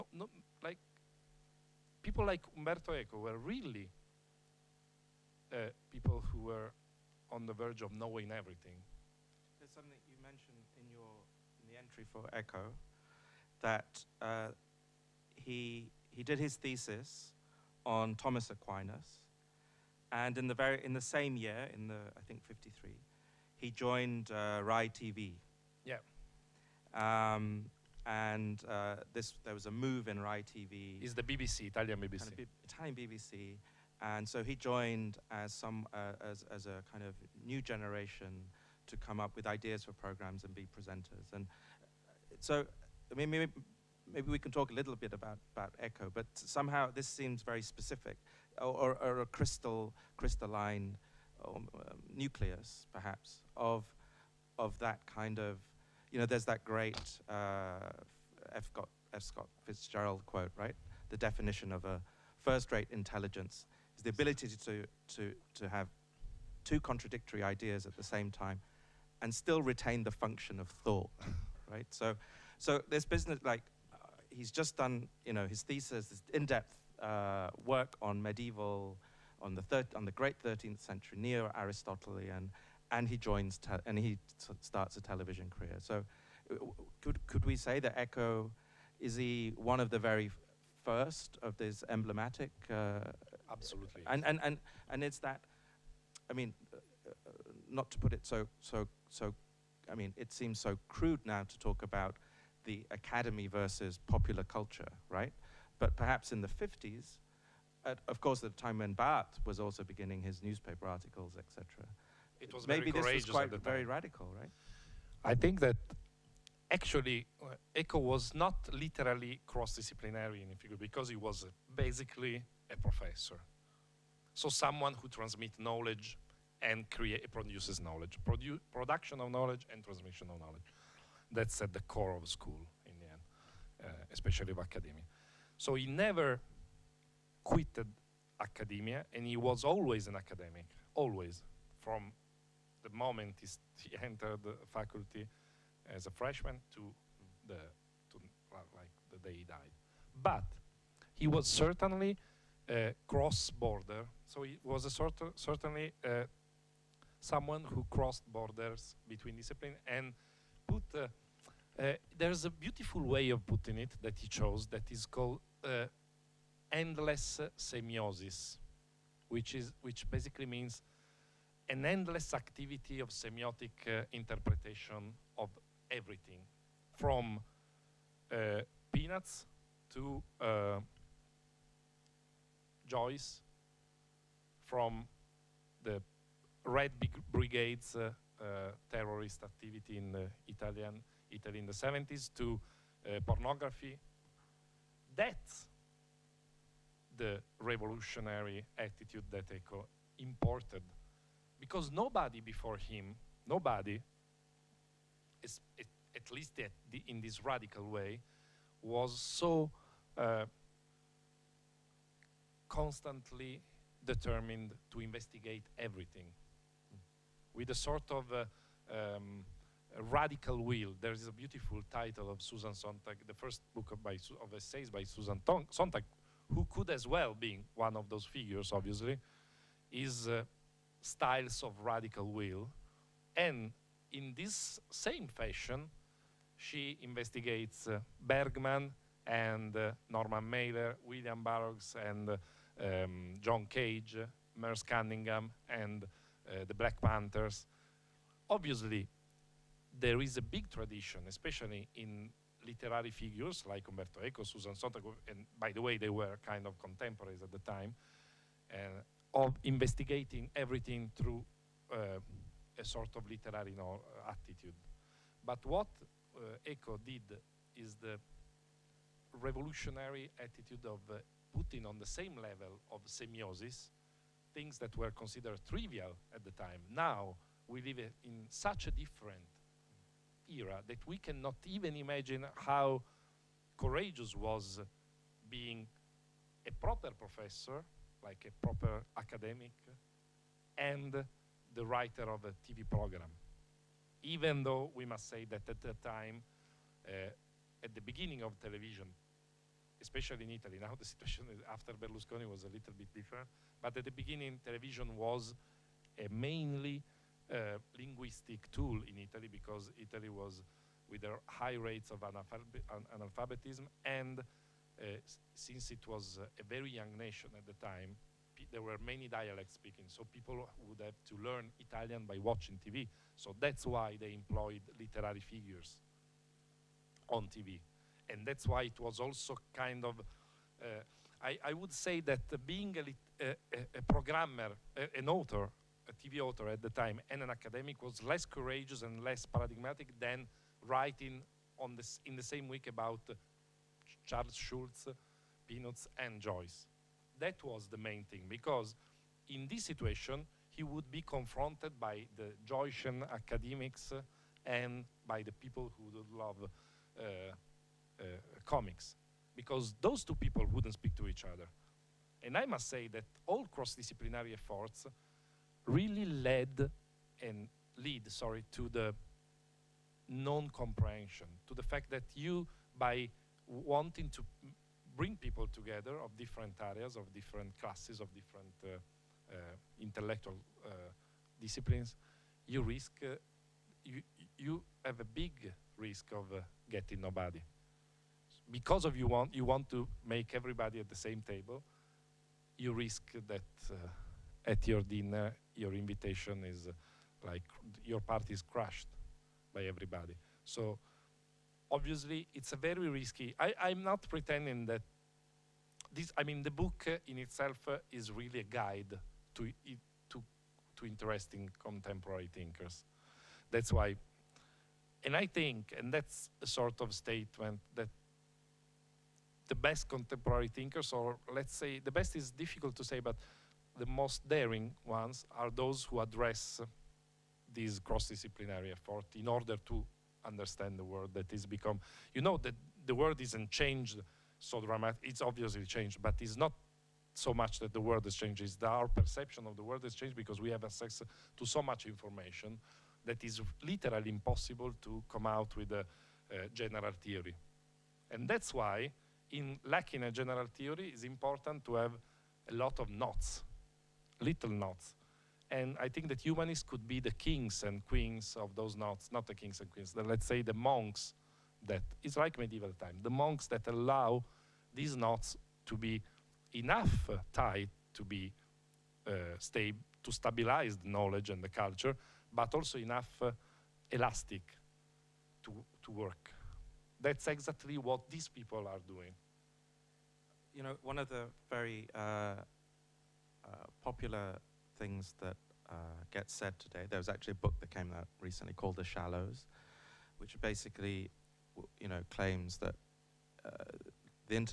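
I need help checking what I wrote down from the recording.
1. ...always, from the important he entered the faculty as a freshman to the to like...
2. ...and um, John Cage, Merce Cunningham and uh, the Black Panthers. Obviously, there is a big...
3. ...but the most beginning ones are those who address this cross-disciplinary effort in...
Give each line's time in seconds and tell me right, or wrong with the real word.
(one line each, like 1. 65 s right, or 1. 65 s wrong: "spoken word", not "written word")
1. 140 s wrong: "moment", not "important"
2. 242 s right
3. 423 s wrong: "daring", not "beginning".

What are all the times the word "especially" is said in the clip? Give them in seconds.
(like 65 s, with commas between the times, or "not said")
134 s, 251 s, 300 s.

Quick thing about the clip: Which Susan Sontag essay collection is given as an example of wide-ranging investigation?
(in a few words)
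Styles of Radical Will.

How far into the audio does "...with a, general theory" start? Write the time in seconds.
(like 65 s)
445 s.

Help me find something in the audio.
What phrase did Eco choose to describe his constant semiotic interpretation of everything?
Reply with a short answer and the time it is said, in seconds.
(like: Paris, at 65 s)
endless semiosis, at 166 s.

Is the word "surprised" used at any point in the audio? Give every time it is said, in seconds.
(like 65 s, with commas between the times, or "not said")
not said.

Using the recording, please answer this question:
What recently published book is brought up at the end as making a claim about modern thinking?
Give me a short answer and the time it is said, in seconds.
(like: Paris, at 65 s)
The Shallows, at 488 s.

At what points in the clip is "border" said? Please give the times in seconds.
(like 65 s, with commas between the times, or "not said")
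153 s, 158 s.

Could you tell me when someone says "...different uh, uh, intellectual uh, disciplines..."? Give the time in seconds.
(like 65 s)
378 s.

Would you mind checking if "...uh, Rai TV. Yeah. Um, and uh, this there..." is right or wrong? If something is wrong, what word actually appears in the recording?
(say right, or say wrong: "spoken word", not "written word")
right.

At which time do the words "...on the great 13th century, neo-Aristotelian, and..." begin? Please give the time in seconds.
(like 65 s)
79 s.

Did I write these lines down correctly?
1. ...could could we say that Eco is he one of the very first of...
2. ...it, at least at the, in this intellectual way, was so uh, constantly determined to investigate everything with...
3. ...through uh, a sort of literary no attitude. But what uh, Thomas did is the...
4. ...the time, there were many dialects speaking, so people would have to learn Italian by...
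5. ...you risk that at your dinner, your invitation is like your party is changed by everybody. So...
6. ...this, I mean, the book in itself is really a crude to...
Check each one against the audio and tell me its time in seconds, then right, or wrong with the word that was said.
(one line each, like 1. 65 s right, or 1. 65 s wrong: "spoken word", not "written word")
1. 87 s right
2. 205 s wrong: "radical", not "intellectual"
3. 261 s wrong: "Eco", not "Thomas"
4. 317 s right
5. 392 s wrong: "crushed", not "changed"
6. 406 s wrong: "guide", not "crude".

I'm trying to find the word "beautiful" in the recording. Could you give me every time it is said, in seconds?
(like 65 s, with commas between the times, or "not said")
162 s, 221 s.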